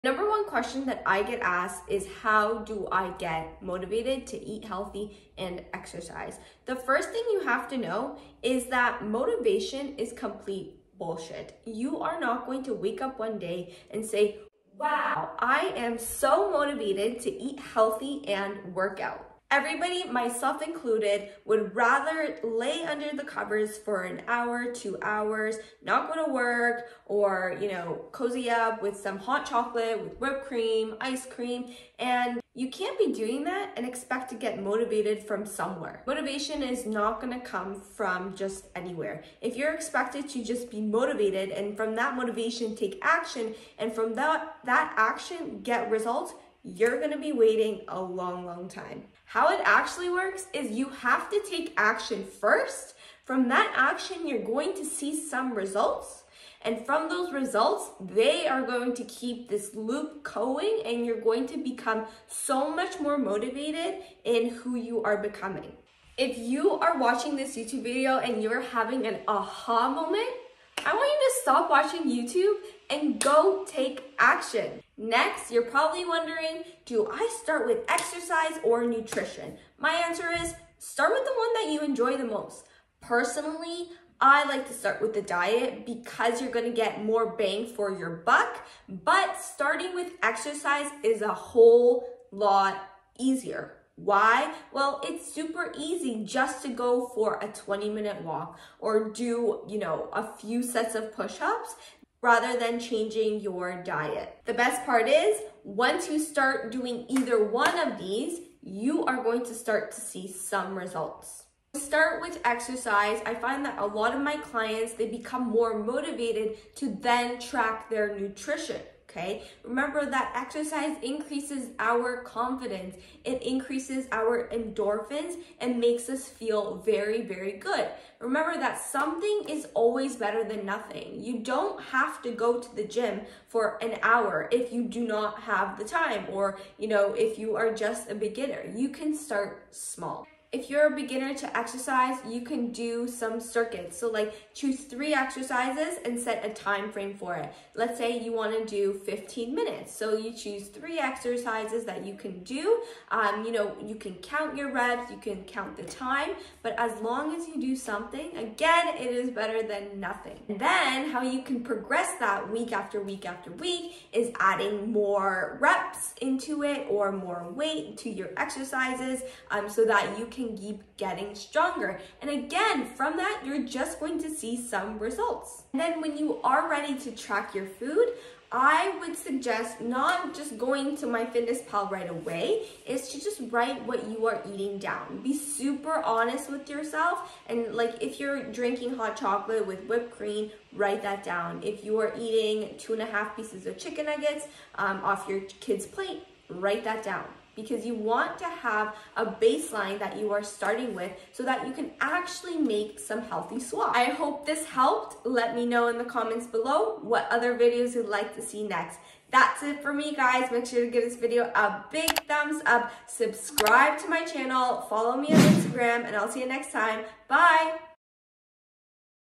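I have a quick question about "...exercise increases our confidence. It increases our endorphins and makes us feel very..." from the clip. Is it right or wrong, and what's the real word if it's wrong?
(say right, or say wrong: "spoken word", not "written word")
right.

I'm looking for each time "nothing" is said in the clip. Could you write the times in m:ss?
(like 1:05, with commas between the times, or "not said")
2:10, 2:40.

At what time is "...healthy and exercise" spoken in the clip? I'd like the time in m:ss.
0:04.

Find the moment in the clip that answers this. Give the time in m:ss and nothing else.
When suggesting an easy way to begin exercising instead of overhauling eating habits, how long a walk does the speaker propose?
1:37.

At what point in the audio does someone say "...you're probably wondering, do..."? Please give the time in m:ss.
1:15.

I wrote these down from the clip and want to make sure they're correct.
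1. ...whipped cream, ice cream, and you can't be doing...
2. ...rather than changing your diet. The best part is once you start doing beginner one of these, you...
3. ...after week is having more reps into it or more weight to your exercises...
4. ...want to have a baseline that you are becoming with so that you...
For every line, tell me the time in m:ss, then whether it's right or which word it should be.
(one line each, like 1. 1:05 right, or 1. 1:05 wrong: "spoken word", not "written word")
1. 0:30 right
2. 1:42 wrong: "either", not "beginner"
3. 2:43 wrong: "adding", not "having"
4. 3:17 wrong: "starting", not "becoming".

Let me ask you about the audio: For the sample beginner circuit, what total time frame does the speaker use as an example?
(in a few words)
15 minutes.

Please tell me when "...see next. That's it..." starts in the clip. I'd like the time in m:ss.
3:28.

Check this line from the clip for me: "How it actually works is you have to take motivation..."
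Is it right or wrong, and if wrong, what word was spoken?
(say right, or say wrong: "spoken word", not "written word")
wrong: "action", not "motivation".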